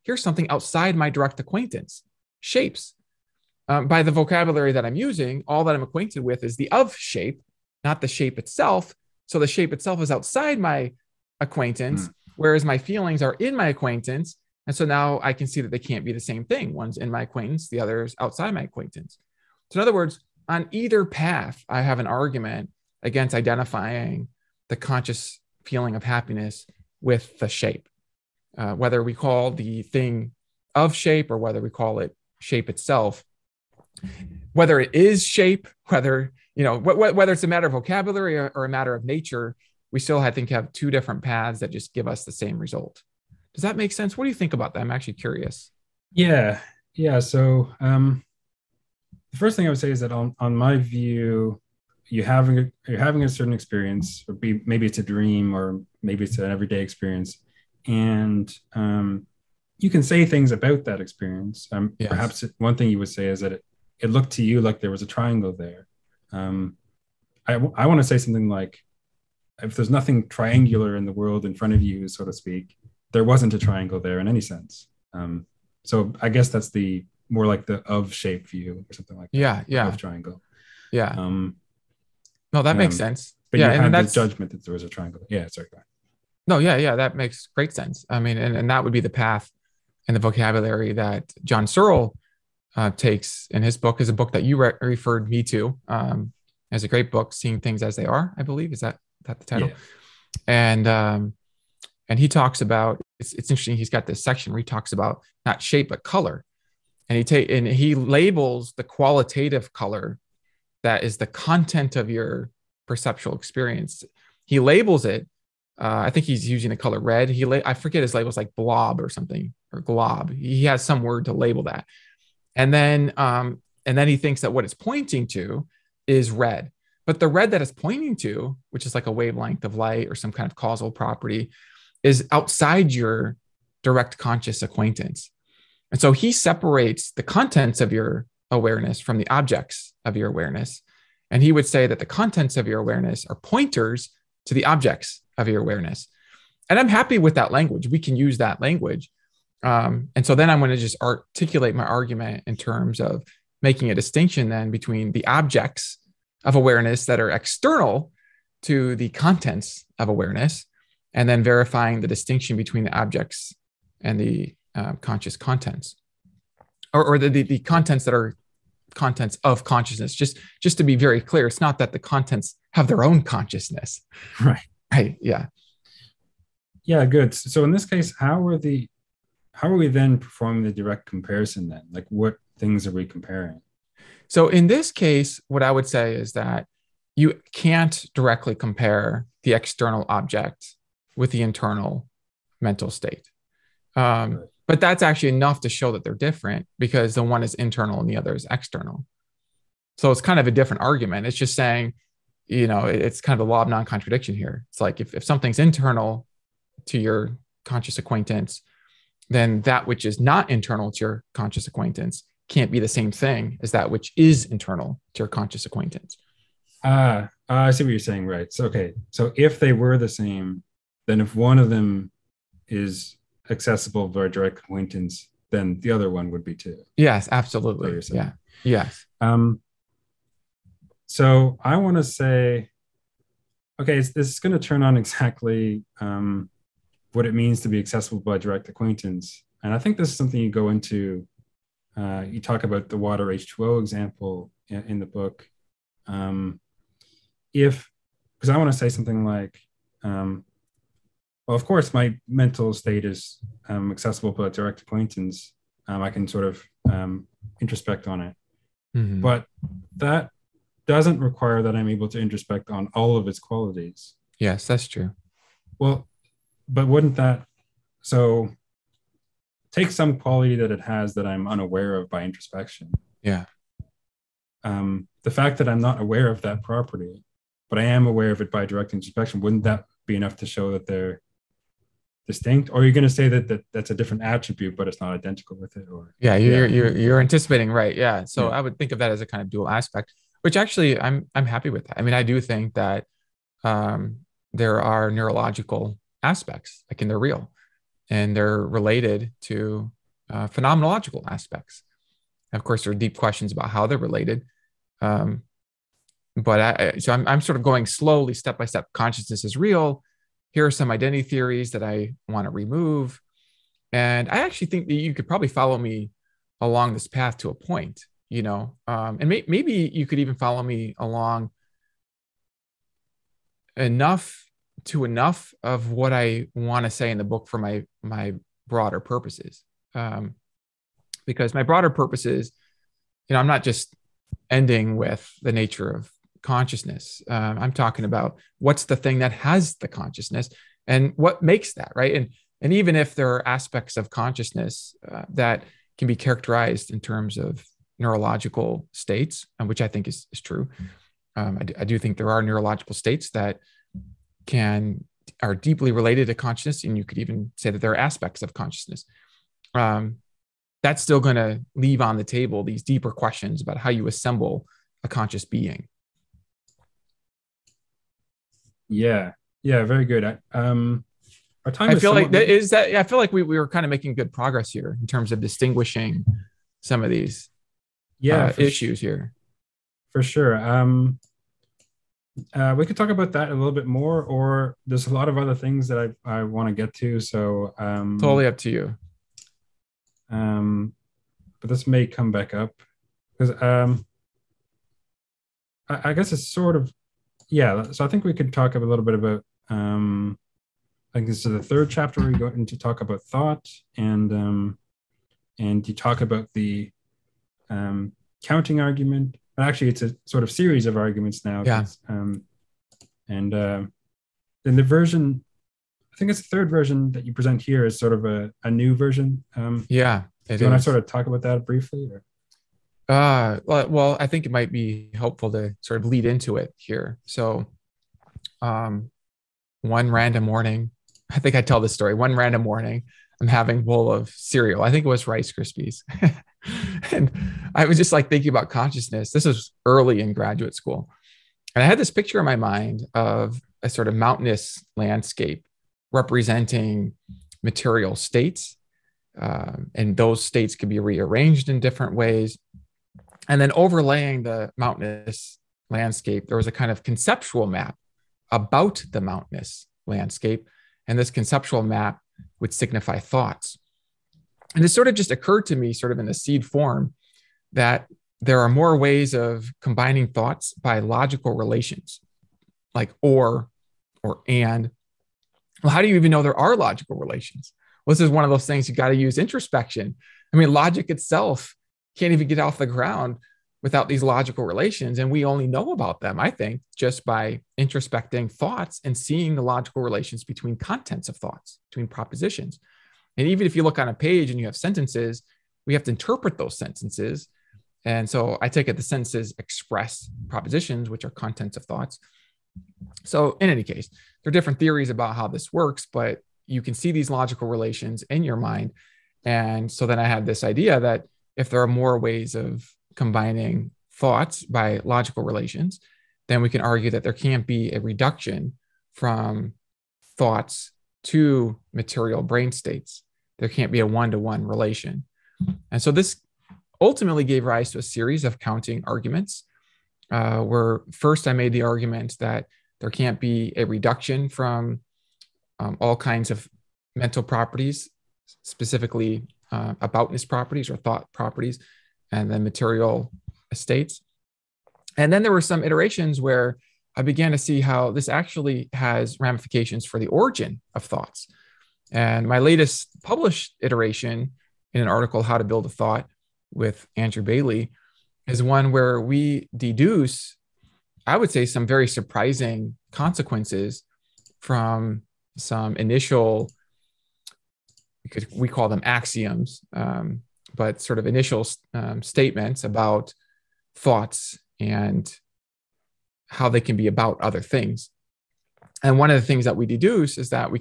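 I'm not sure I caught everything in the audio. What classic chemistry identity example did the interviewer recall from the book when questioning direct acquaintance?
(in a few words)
water H2O.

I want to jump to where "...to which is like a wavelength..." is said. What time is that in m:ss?
2:08.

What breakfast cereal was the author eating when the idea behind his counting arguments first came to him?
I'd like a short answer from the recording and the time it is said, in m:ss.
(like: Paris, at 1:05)
Rice Krispies, at 7:15.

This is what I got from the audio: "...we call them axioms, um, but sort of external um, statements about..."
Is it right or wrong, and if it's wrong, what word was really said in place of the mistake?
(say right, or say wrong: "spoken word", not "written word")
wrong: "initial", not "external".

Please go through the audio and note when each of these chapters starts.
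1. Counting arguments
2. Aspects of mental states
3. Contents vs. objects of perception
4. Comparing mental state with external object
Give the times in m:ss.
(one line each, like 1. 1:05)
1. 6:38
2. 3:51
3. 0:50
4. 2:56.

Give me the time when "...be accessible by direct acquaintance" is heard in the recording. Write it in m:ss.
3:57.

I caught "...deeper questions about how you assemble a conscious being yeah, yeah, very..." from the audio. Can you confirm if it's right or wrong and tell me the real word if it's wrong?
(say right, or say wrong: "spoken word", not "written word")
right.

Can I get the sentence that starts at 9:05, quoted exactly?
And then there were some iterations where I began to see how this actually has ramifications for the origin of thoughts.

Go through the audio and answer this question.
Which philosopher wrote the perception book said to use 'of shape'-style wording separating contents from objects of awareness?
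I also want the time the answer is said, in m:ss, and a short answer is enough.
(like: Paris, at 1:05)
John Searle, at 1:31.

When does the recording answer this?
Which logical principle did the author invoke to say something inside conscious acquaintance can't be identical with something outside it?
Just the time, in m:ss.
3:23.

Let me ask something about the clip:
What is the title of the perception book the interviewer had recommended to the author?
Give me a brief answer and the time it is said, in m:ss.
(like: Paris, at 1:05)
Seeing Things as They Are, at 1:37.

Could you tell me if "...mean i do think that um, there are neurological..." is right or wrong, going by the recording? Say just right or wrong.
right.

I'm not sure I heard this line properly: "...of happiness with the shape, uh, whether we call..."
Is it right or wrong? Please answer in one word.
right.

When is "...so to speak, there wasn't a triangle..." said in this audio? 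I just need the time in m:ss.
1:12.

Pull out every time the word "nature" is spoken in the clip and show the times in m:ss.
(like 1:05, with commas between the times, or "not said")
0:39, 5:35.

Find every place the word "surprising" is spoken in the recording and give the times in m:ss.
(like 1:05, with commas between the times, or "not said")
9:22.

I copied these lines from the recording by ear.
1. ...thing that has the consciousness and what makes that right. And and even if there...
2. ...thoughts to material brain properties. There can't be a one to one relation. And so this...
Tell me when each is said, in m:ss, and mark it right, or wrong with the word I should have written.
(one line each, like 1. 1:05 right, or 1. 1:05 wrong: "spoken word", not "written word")
1. 5:38 right
2. 8:40 wrong: "states", not "properties".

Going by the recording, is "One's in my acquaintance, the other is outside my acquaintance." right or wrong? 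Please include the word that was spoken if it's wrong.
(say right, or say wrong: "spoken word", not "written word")
right.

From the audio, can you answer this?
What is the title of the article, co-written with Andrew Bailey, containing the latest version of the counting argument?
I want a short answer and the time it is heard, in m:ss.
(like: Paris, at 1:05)
How to Build a Thought, at 9:15.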